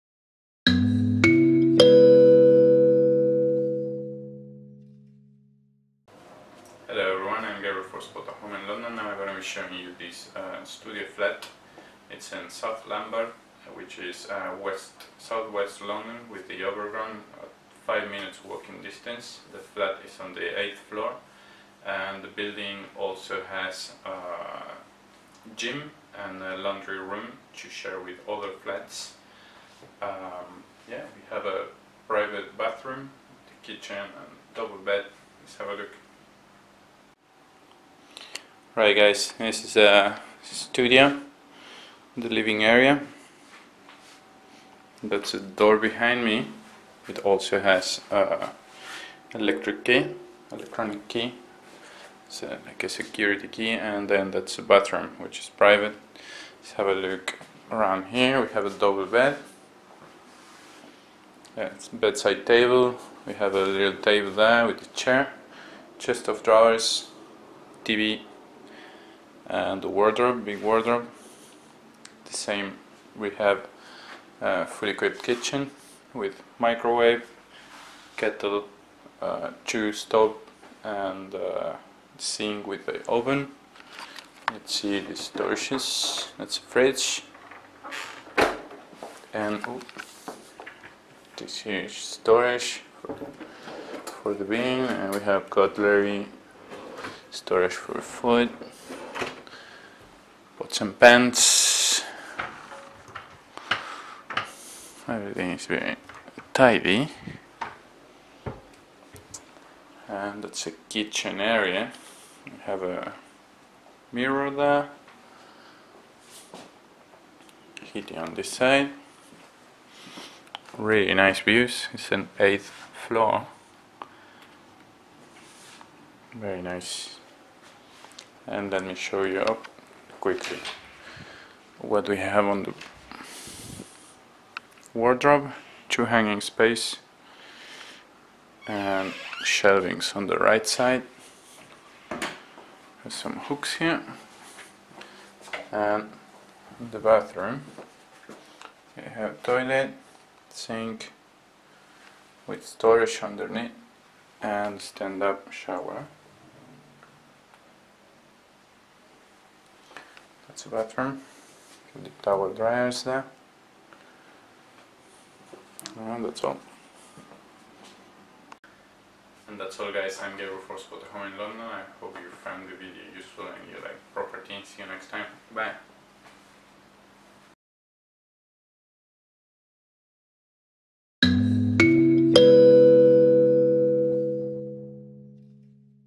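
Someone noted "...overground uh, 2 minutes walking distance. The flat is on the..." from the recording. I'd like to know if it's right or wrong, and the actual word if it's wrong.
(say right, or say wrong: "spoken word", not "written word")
wrong: "5", not "2".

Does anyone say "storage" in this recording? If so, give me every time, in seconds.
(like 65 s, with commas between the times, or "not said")
85 s, 91 s, 97 s, 152 s.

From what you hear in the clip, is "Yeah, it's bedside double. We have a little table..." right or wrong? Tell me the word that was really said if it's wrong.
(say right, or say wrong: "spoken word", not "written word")
wrong: "table", not "double".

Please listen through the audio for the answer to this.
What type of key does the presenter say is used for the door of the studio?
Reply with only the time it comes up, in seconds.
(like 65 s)
50 s.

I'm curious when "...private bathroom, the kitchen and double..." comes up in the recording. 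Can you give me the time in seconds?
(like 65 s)
32 s.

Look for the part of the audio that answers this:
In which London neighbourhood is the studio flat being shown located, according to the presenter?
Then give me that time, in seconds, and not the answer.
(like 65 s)
12 s.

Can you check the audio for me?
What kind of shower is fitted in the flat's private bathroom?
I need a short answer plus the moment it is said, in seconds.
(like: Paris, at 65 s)
stand-up shower, at 154 s.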